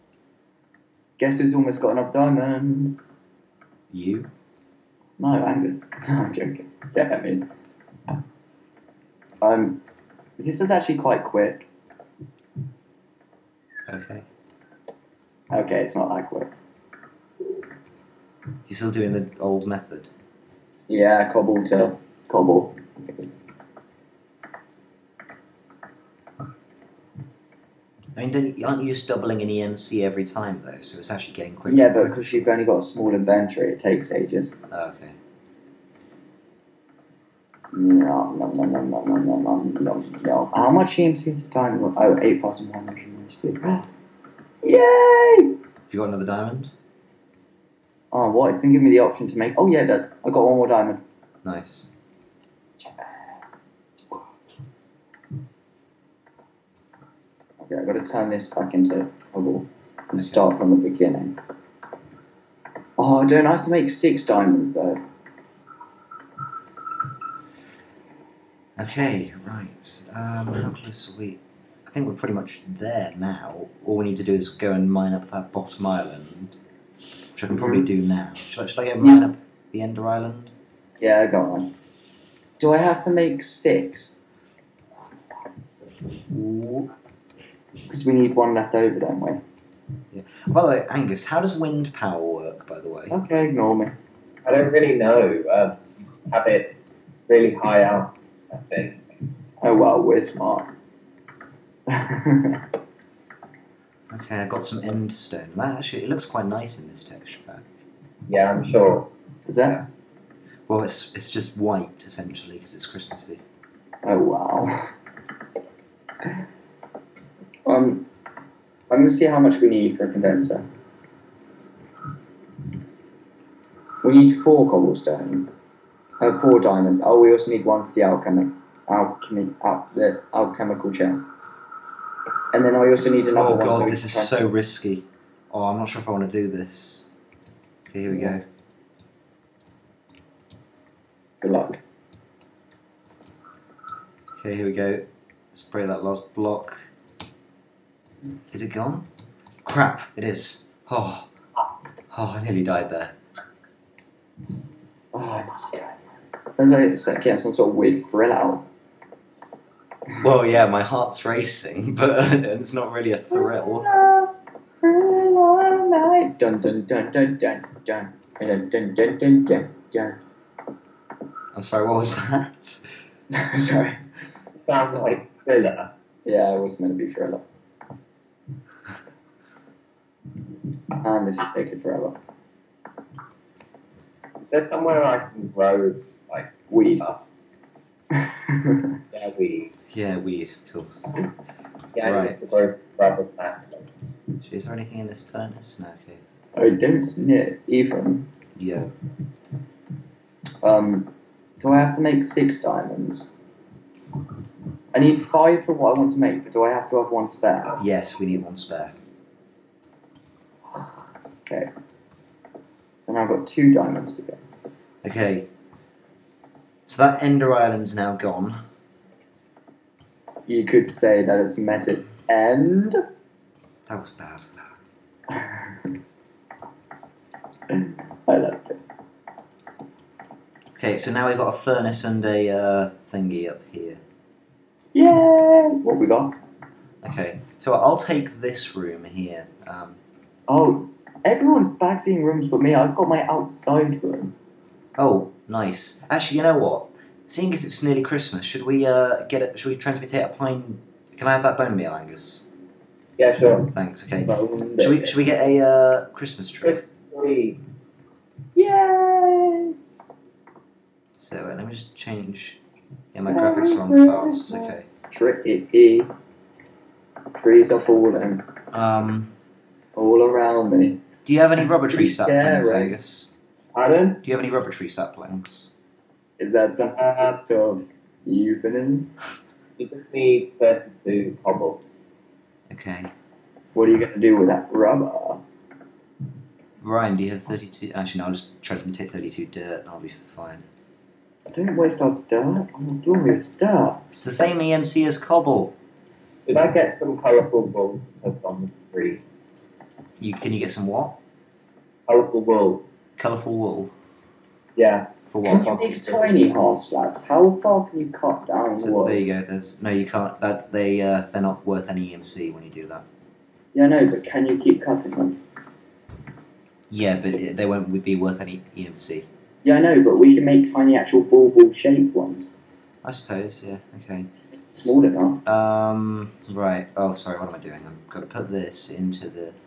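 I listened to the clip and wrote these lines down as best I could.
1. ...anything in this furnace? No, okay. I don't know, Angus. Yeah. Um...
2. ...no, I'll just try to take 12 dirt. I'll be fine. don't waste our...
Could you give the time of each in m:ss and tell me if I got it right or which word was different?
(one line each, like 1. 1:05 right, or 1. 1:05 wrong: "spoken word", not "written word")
1. 3:14 wrong: "Ephraim", not "Angus"
2. 4:48 wrong: "32", not "12".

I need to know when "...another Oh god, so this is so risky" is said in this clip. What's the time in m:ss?
2:13.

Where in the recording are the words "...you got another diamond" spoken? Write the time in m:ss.
0:45.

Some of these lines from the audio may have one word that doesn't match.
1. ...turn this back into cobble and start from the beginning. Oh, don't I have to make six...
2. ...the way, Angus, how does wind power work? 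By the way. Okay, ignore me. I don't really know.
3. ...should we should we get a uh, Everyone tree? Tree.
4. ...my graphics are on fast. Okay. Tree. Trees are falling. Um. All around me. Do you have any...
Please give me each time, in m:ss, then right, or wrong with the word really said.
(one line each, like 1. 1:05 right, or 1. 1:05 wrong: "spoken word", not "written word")
1. 0:58 right
2. 1:30 right
3. 4:14 wrong: "Christmas", not "Everyone"
4. 4:23 right.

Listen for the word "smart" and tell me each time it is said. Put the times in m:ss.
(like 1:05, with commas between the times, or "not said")
1:40.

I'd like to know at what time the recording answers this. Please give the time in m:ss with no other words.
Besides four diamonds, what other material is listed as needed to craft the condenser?
2:04.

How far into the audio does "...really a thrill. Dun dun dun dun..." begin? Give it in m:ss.
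2:42.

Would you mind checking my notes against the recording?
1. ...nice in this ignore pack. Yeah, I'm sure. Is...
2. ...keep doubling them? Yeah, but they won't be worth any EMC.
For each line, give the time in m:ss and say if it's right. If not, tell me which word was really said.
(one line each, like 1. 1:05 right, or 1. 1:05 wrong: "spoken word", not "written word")
1. 1:46 wrong: "texture", not "ignore"
2. 5:14 wrong: "cutting", not "doubling".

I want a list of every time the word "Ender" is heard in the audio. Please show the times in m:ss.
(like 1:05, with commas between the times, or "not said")
1:19, 3:37.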